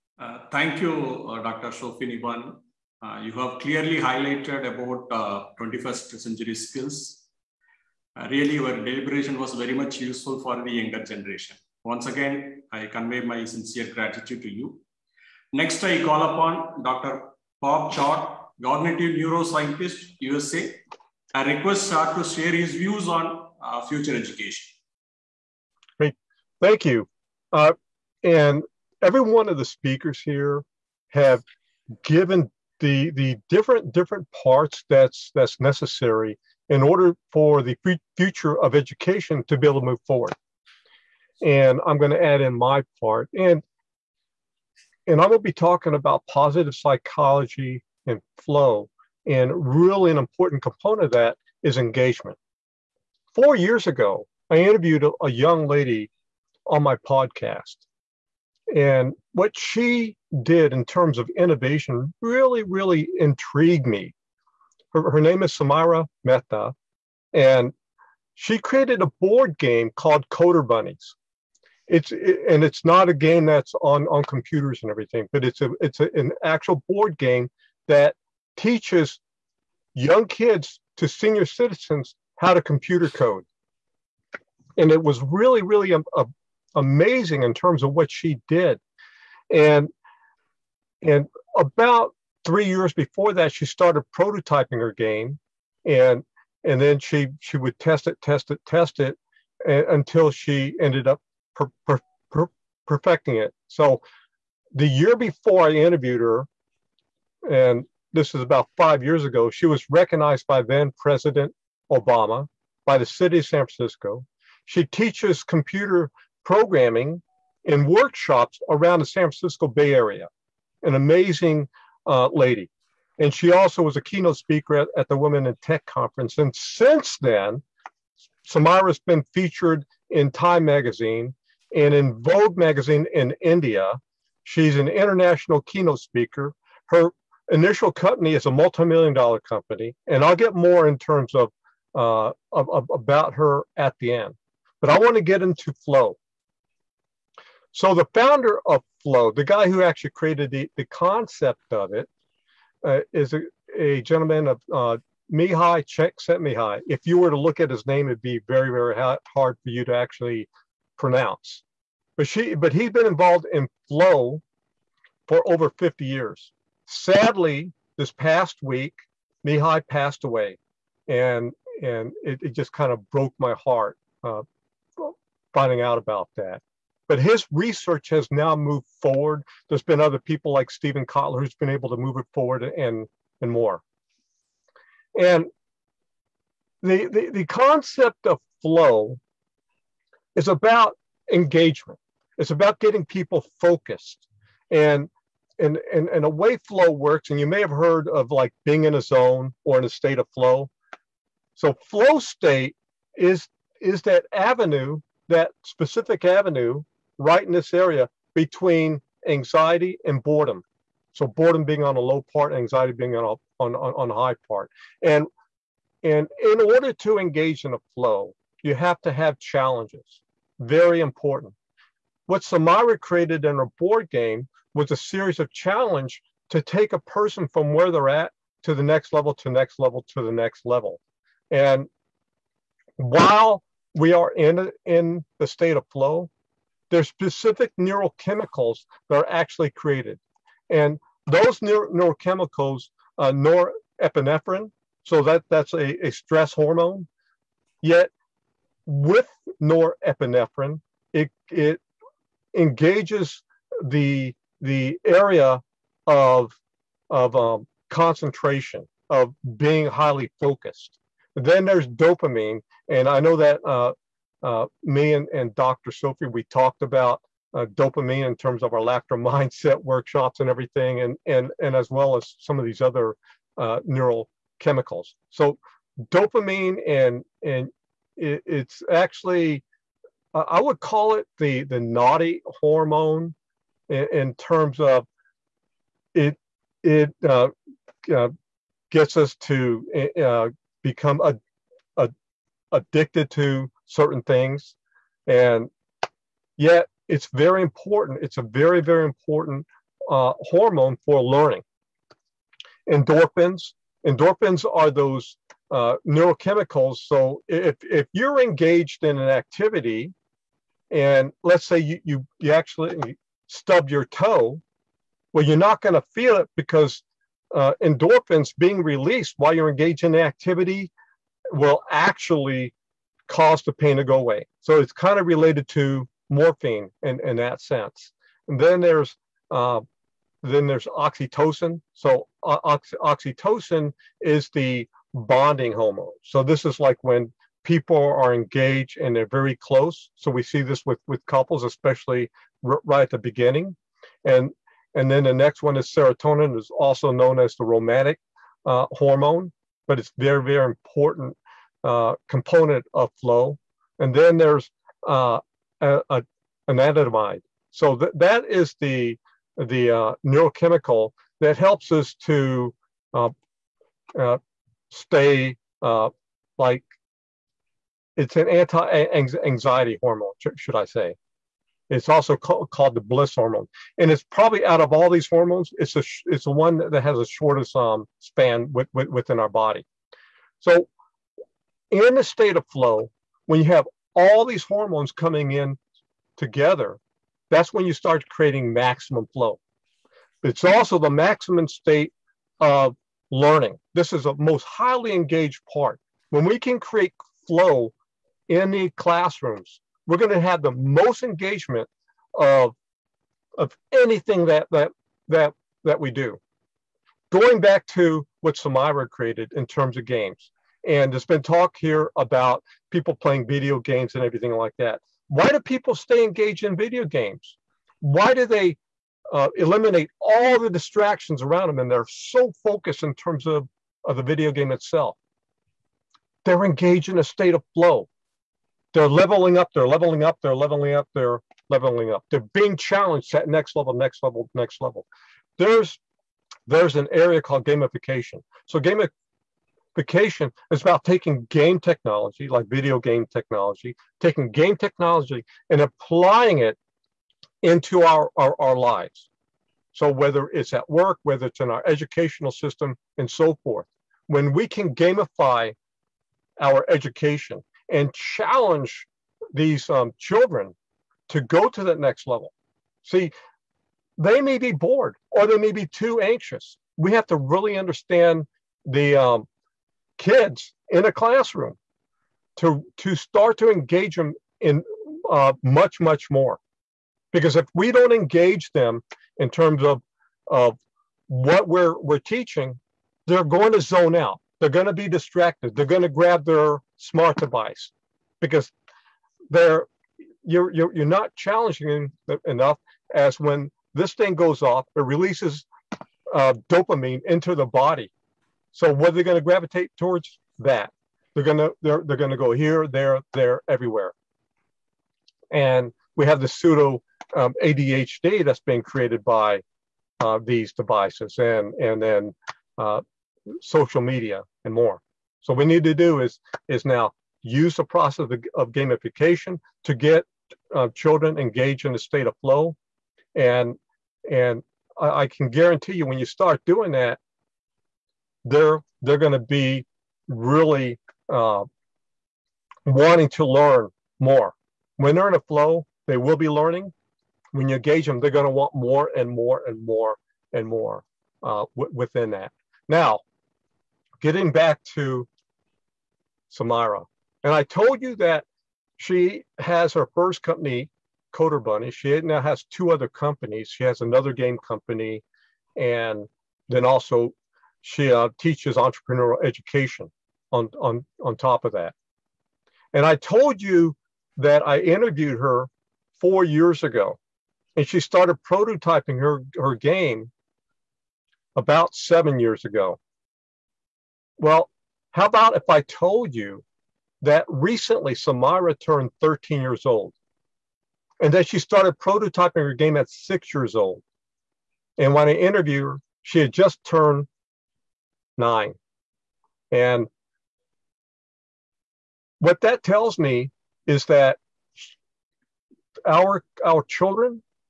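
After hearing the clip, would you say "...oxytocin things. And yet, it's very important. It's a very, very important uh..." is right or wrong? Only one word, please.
wrong.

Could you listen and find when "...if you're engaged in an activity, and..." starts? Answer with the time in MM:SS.
05:07.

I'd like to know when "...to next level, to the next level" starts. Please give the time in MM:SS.
03:49.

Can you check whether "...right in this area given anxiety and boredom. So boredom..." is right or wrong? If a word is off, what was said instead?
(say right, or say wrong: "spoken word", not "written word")
wrong: "between", not "given".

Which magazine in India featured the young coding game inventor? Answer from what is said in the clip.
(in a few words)
Vogue.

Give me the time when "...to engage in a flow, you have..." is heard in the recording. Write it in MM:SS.
03:36.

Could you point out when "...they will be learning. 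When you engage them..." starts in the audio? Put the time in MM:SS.
08:56.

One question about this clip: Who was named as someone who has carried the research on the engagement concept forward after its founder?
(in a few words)
Steven Kotler.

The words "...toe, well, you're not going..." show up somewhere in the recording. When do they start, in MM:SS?
05:14.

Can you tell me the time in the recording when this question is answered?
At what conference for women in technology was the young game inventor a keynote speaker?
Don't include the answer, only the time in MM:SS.
02:05.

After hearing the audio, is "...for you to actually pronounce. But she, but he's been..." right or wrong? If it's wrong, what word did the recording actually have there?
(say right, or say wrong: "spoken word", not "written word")
right.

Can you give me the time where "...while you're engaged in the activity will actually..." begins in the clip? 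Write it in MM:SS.
05:19.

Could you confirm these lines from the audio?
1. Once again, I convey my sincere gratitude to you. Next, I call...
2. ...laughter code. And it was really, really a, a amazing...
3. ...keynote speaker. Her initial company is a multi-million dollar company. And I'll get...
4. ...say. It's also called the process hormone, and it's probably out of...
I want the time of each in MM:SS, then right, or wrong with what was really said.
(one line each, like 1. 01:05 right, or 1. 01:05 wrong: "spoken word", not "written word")
1. 00:11 right
2. 01:22 wrong: "computer", not "laughter"
3. 02:15 right
4. 06:10 wrong: "bliss", not "process".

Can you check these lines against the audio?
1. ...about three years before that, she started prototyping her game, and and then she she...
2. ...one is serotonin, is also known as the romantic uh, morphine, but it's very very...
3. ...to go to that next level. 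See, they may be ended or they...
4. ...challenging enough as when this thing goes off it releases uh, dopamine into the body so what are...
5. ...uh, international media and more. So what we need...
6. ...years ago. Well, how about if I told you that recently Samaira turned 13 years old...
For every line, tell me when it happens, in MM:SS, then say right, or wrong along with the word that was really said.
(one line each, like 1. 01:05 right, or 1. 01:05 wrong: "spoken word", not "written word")
1. 01:31 right
2. 05:45 wrong: "hormone", not "morphine"
3. 07:41 wrong: "bored", not "ended"
4. 08:11 right
5. 08:32 wrong: "social", not "international"
6. 09:32 right.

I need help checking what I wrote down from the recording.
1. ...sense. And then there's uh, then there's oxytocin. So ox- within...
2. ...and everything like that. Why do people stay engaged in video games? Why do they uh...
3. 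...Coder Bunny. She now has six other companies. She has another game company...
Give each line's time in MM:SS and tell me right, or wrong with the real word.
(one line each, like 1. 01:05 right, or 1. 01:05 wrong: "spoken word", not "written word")
1. 05:27 wrong: "oxytocin", not "within"
2. 06:54 right
3. 09:11 wrong: "two", not "six".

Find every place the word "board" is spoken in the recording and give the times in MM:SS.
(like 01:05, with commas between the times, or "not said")
01:09, 01:16, 03:43.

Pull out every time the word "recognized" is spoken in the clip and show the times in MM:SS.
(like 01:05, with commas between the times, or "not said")
01:49.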